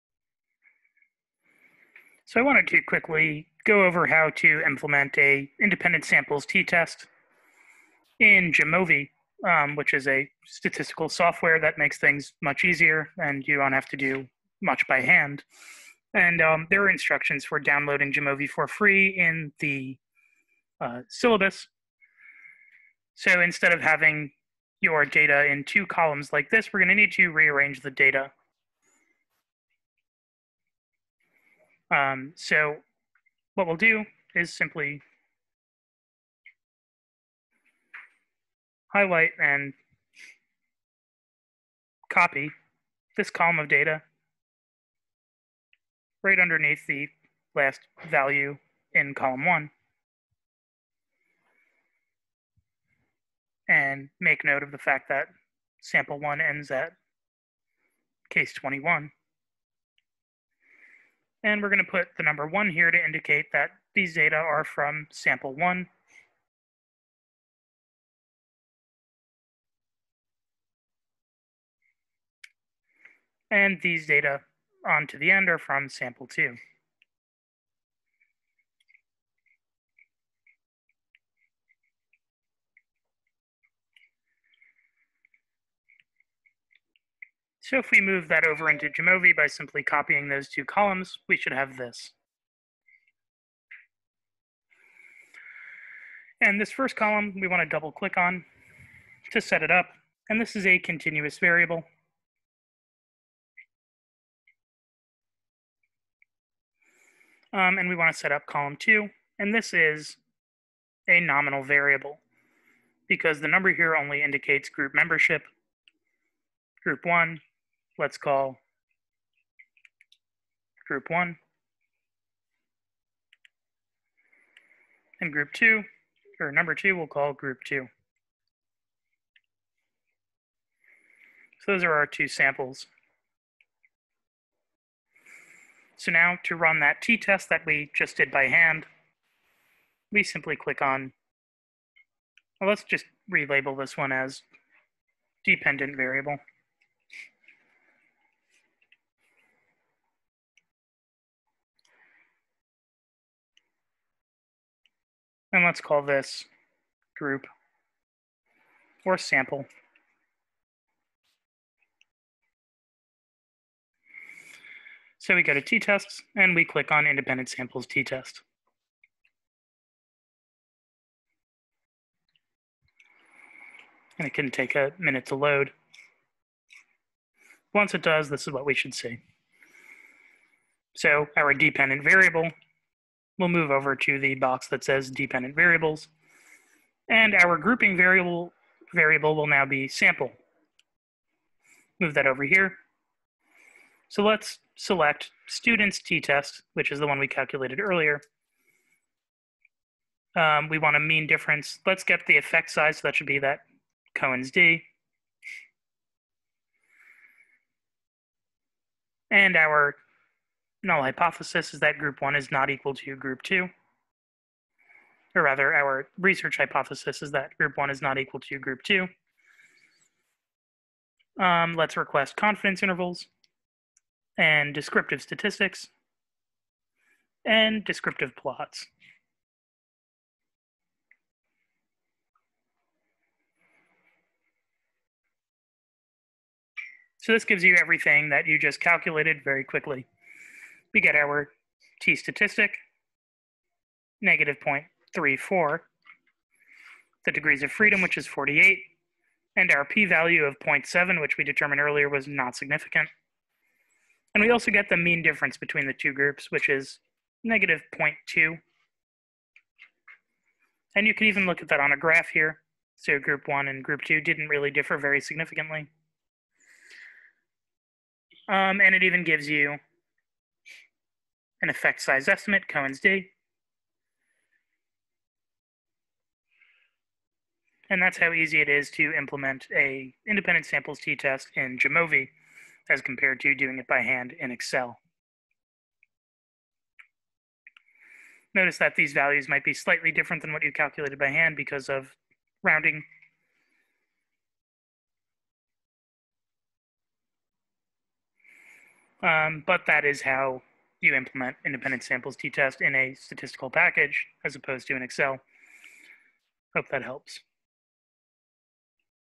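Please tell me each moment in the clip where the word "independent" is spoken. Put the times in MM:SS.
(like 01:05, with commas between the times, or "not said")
00:05, 02:47, 04:40, 05:01.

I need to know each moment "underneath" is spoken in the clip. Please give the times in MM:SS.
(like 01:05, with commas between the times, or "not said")
00:46.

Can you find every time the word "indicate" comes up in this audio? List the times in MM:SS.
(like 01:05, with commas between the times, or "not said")
01:03, 01:54.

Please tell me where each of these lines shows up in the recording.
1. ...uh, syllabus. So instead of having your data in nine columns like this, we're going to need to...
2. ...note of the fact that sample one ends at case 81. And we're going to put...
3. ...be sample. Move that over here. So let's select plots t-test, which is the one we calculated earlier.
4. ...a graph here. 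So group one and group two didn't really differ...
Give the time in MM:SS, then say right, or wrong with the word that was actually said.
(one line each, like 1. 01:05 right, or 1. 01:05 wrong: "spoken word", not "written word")
1. 00:20 wrong: "two", not "nine"
2. 00:54 wrong: "21", not "81"
3. 03:09 wrong: "students", not "plots"
4. 04:21 right.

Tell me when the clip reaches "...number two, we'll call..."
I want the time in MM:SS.
02:06.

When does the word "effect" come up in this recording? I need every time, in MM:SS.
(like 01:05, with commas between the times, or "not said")
03:22, 04:31.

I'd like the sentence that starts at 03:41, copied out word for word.
Um, let's request confidence intervals and descriptive statistics and descriptive plots.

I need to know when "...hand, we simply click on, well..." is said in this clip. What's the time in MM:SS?
02:18.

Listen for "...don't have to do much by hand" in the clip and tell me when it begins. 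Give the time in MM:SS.
00:13.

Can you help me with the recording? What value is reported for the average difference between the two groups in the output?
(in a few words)
-0.2.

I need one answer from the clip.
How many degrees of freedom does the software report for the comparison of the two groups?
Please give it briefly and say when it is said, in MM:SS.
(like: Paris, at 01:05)
48, at 04:08.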